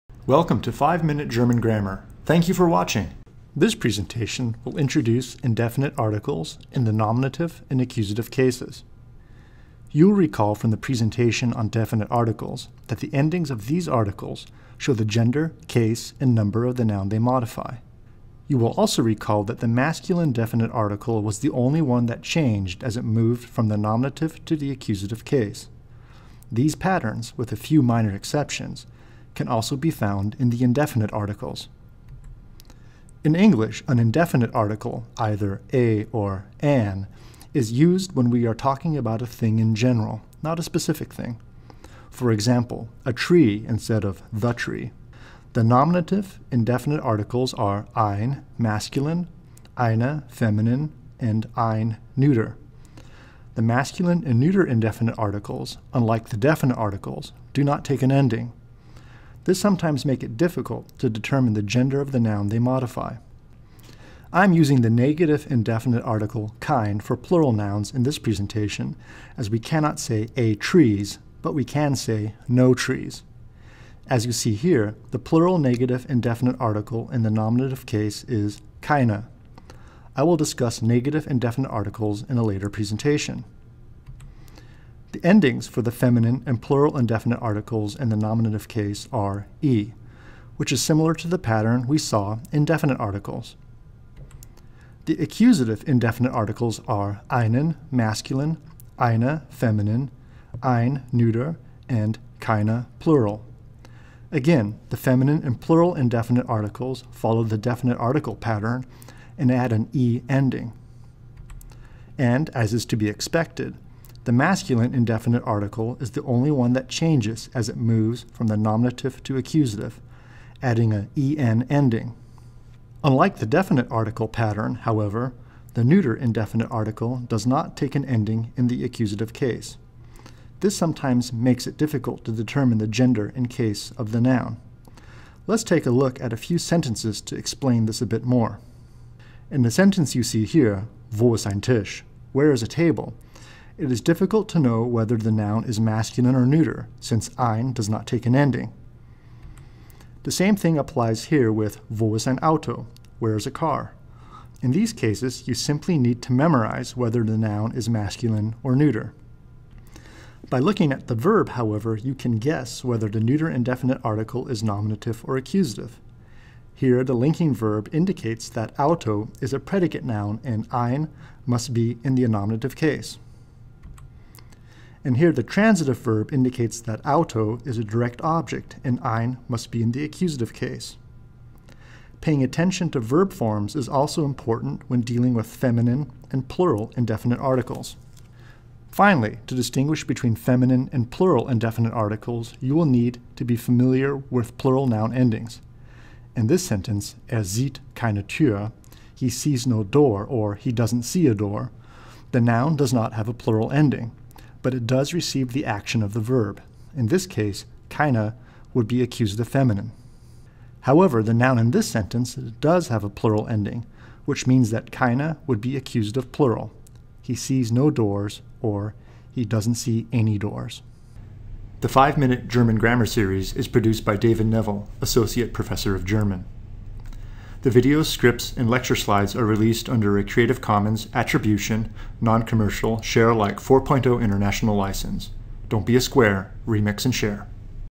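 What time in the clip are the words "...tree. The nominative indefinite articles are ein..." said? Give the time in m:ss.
0:44.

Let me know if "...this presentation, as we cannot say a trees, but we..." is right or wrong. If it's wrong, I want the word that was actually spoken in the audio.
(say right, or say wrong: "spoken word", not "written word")
right.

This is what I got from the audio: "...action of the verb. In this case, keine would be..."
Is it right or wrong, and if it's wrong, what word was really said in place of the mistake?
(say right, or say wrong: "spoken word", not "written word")
right.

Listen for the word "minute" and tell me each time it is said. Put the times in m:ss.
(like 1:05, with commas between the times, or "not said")
0:00, 3:42.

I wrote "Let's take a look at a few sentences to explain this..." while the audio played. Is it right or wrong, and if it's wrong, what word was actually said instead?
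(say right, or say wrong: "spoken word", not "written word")
right.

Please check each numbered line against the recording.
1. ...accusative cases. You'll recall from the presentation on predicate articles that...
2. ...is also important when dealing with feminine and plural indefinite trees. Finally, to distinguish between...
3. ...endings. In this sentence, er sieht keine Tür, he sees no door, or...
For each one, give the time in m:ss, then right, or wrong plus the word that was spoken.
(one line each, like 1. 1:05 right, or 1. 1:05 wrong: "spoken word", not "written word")
1. 0:07 wrong: "definite", not "predicate"
2. 3:03 wrong: "articles", not "trees"
3. 3:15 right.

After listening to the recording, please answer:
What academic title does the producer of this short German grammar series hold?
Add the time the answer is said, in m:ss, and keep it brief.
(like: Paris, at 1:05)
Associate Professor of German, at 3:45.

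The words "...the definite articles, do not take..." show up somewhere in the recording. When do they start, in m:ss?
0:56.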